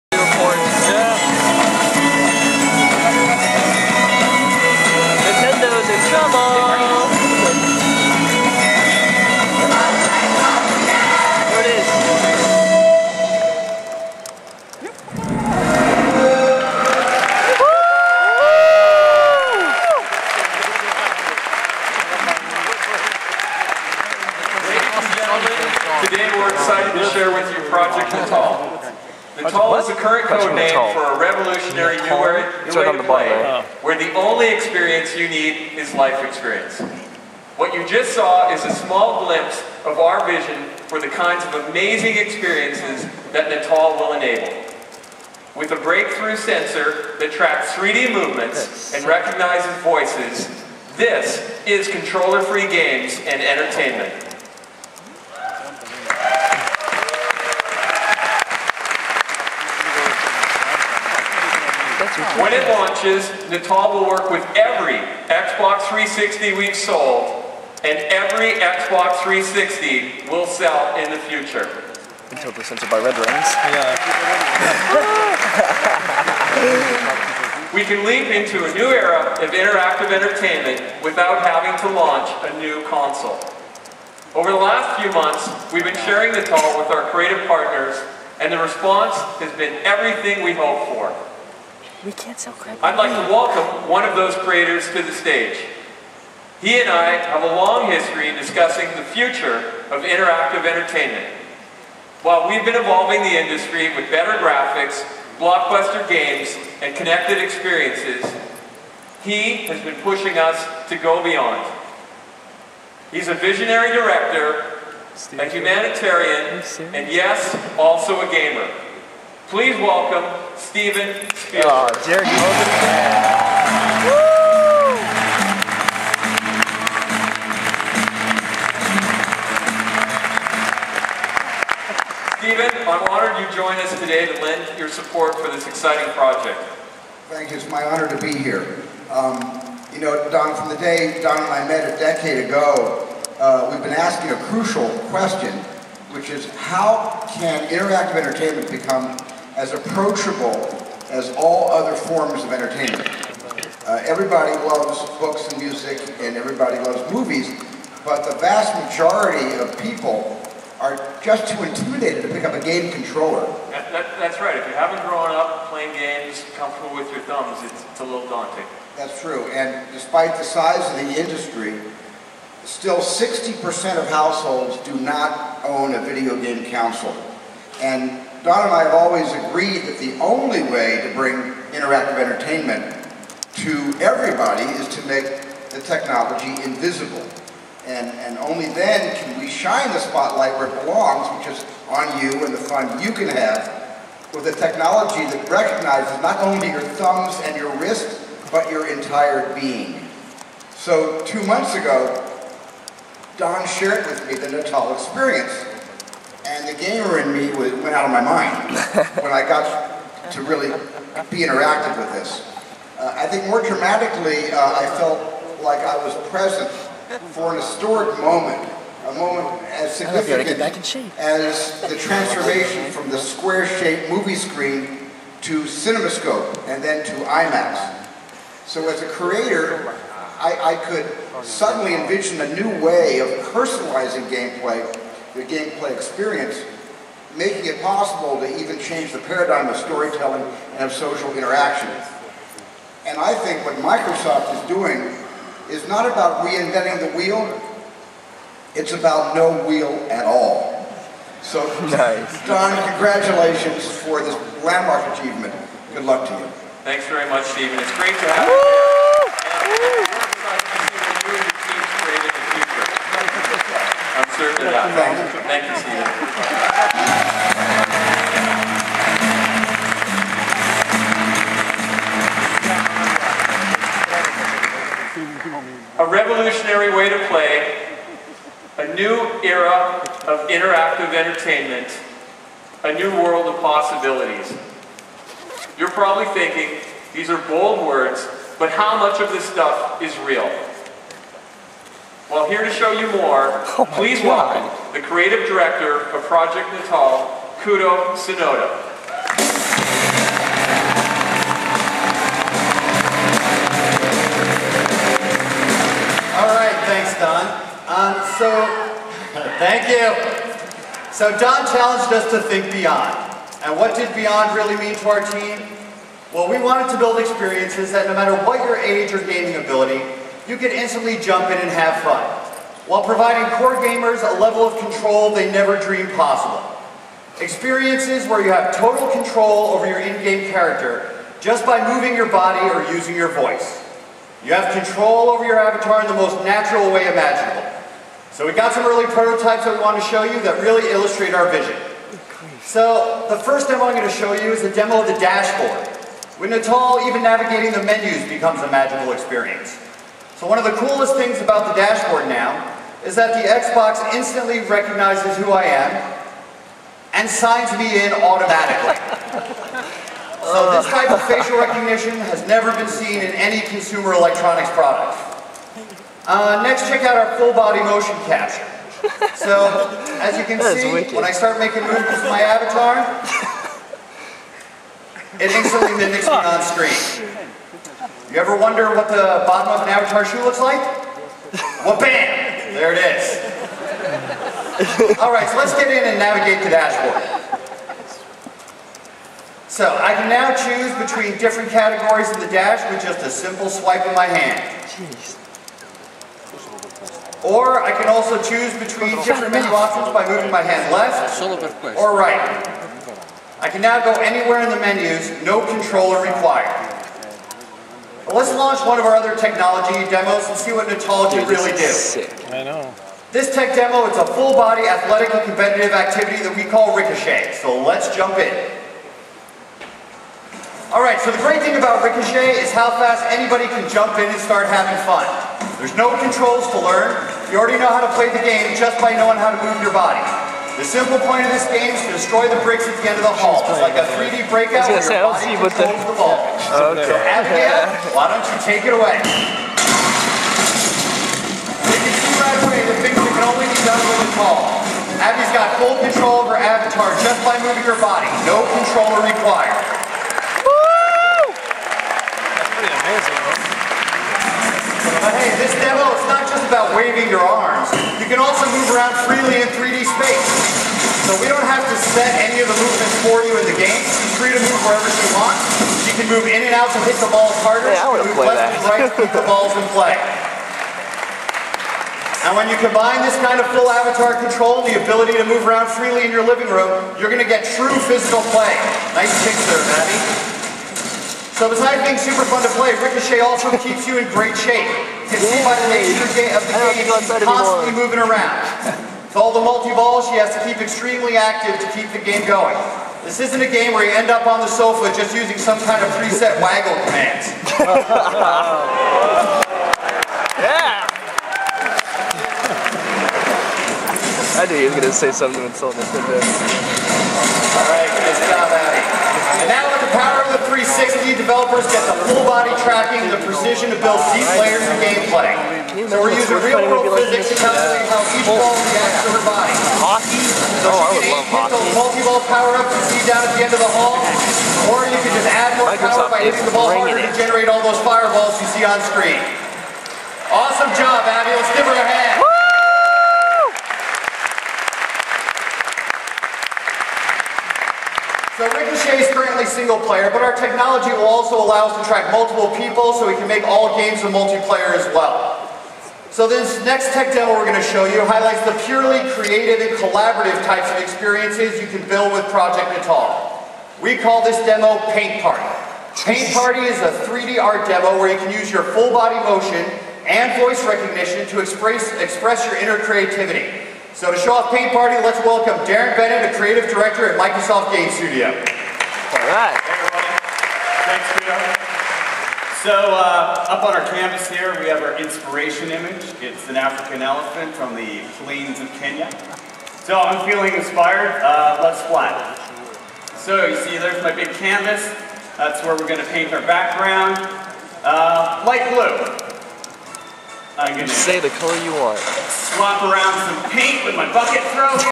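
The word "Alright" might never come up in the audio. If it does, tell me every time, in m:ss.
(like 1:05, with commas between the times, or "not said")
7:00, 8:25.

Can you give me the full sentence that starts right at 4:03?
And I think what Microsoft is doing is not about reinventing the wheel, it's about no wheel at all.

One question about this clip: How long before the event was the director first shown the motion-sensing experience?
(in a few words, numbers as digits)
two months.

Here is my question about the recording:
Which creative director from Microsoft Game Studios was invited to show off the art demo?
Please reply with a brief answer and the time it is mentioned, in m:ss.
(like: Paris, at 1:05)
Darren Bennett, at 9:25.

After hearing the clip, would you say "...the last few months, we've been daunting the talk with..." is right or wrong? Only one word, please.
wrong.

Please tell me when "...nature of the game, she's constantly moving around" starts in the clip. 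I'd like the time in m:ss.
8:05.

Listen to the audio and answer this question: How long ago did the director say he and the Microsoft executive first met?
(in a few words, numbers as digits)
a decade.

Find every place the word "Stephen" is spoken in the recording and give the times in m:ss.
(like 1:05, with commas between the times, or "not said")
2:12, 4:17.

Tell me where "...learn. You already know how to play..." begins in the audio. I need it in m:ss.
7:06.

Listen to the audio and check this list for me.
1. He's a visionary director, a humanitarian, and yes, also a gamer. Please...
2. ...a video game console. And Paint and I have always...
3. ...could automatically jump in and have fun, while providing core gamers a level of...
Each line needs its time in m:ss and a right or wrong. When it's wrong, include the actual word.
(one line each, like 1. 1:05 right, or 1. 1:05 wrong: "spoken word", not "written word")
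1. 1:53 right
2. 2:55 wrong: "Don", not "Paint"
3. 5:20 wrong: "instantly", not "automatically".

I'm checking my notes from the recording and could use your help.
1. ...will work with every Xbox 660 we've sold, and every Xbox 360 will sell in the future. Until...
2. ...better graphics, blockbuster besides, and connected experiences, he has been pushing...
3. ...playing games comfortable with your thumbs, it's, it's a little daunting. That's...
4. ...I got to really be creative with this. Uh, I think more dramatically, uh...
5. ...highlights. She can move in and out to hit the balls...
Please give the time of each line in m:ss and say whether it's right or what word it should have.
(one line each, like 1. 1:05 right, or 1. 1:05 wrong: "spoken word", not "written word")
1. 1:03 wrong: "360", not "660"
2. 1:44 wrong: "games", not "besides"
3. 2:45 right
4. 3:29 wrong: "interactive", not "creative"
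5. 7:45 wrong: "wants", not "highlights".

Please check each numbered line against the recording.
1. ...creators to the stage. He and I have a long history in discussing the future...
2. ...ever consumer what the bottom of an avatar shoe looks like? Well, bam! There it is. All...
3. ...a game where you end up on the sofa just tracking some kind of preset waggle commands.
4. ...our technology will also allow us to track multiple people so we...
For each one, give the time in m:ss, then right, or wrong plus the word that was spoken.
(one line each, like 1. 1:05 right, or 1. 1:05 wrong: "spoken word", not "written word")
1. 1:34 right
2. 6:18 wrong: "wonder", not "consumer"
3. 8:13 wrong: "using", not "tracking"
4. 9:00 right.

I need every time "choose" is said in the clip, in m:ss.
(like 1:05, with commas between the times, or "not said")
6:30, 6:38.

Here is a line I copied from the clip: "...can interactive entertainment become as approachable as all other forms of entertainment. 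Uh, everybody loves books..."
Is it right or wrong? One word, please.
right.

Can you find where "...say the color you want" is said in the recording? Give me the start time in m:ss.
9:51.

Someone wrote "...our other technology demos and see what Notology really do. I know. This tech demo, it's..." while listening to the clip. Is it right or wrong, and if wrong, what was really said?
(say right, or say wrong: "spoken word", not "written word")
right.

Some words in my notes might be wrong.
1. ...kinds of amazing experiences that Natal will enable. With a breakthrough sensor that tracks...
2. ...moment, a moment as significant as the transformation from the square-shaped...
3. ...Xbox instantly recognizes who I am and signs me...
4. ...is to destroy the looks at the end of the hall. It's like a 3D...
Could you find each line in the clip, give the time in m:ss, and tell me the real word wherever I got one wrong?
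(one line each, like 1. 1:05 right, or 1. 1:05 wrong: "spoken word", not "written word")
1. 0:41 right
2. 3:38 right
3. 5:53 right
4. 7:11 wrong: "bricks", not "looks".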